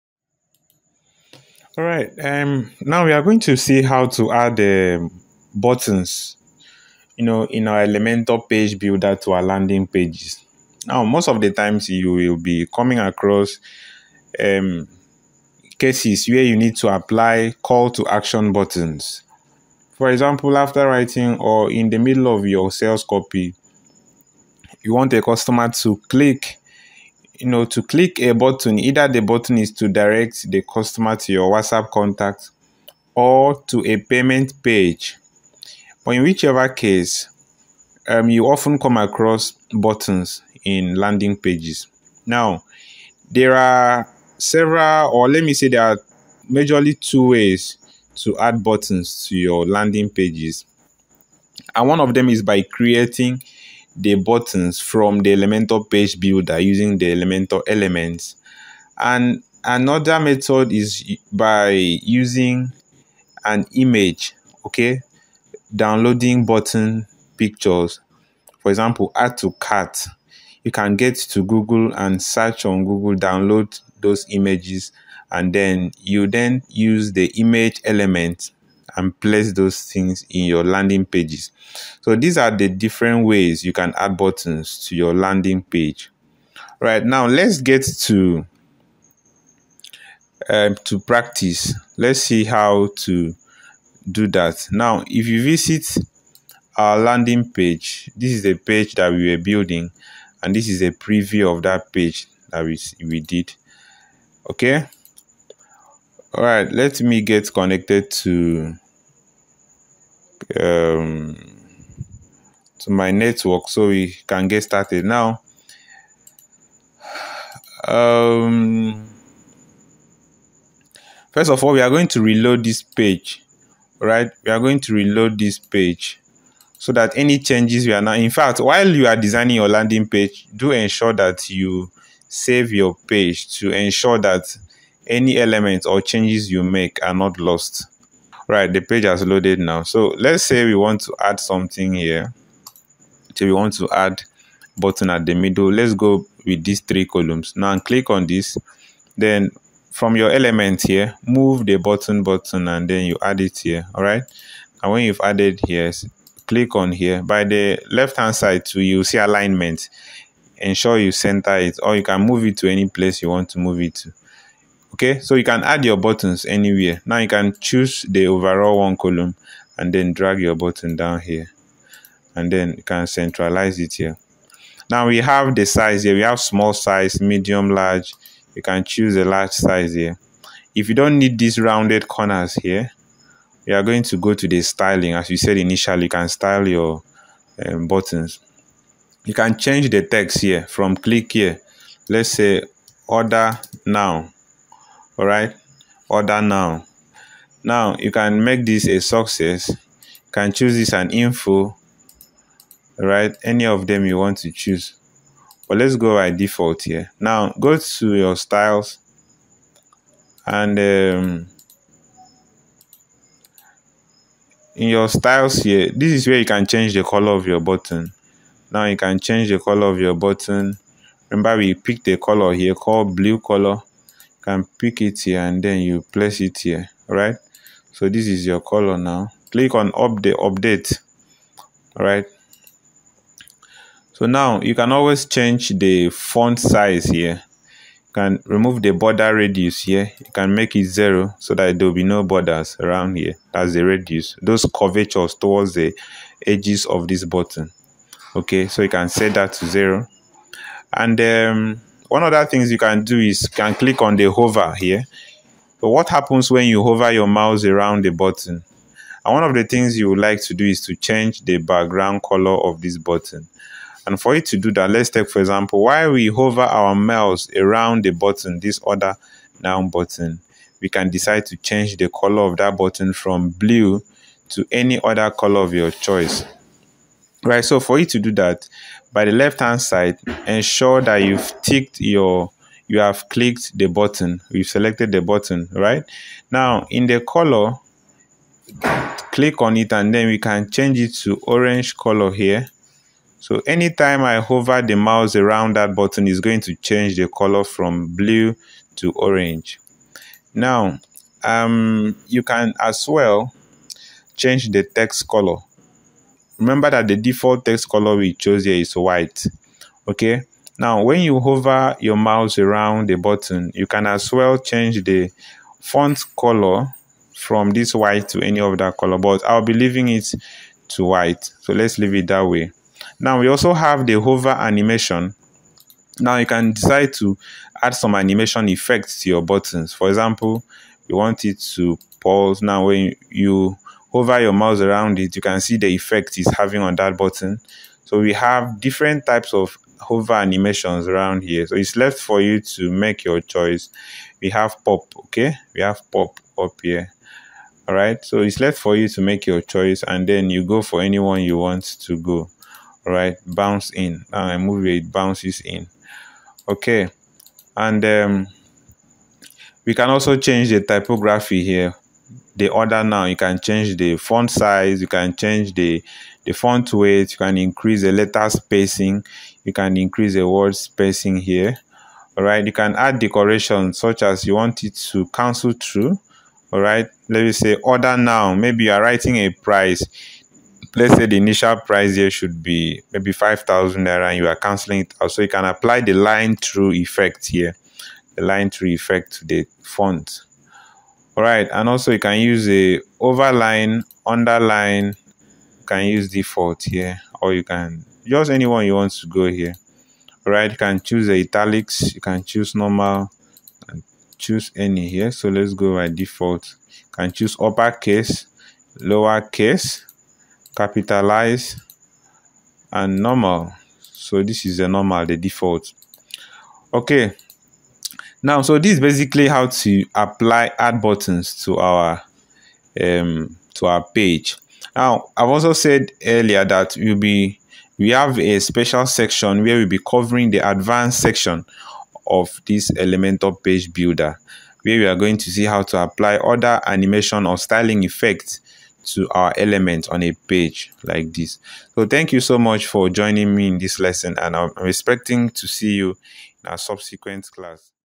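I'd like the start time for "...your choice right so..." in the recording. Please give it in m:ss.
4:35.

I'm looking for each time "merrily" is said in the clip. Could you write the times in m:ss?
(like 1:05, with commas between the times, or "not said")
not said.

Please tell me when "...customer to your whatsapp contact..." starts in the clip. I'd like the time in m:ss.
0:30.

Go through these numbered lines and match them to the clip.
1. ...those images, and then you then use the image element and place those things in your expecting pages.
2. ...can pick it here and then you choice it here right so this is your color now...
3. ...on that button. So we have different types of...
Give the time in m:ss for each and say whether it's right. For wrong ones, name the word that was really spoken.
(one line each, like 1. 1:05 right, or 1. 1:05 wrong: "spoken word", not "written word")
1. 1:13 wrong: "landing", not "expecting"
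2. 3:44 wrong: "place", not "choice"
3. 5:36 right.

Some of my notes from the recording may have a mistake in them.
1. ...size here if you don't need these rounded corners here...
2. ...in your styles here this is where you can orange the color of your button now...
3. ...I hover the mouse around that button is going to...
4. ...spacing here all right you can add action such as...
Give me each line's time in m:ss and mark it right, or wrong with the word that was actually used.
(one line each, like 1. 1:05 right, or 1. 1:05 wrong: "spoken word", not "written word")
1. 2:59 right
2. 3:34 wrong: "change", not "orange"
3. 4:54 right
4. 6:10 wrong: "decoration", not "action".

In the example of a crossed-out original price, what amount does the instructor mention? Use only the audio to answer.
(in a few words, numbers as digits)
5000 naira.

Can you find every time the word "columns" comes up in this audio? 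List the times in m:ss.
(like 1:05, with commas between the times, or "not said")
2:27, 2:48.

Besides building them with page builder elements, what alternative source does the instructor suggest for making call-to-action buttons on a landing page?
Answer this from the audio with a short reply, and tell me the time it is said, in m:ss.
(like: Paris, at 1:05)
an image, at 1:03.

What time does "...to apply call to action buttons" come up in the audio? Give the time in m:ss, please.
0:16.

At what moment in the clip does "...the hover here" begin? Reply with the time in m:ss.
4:14.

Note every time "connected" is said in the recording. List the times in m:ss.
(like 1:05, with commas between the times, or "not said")
1:47.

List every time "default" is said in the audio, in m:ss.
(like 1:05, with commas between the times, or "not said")
3:26, 5:07, 6:36, 6:46, 6:55.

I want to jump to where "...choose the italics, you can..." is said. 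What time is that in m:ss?
6:40.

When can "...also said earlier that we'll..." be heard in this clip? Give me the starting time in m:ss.
7:05.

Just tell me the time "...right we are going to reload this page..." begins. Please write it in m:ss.
2:03.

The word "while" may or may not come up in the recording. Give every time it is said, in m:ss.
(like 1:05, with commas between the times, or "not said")
2:08, 4:25.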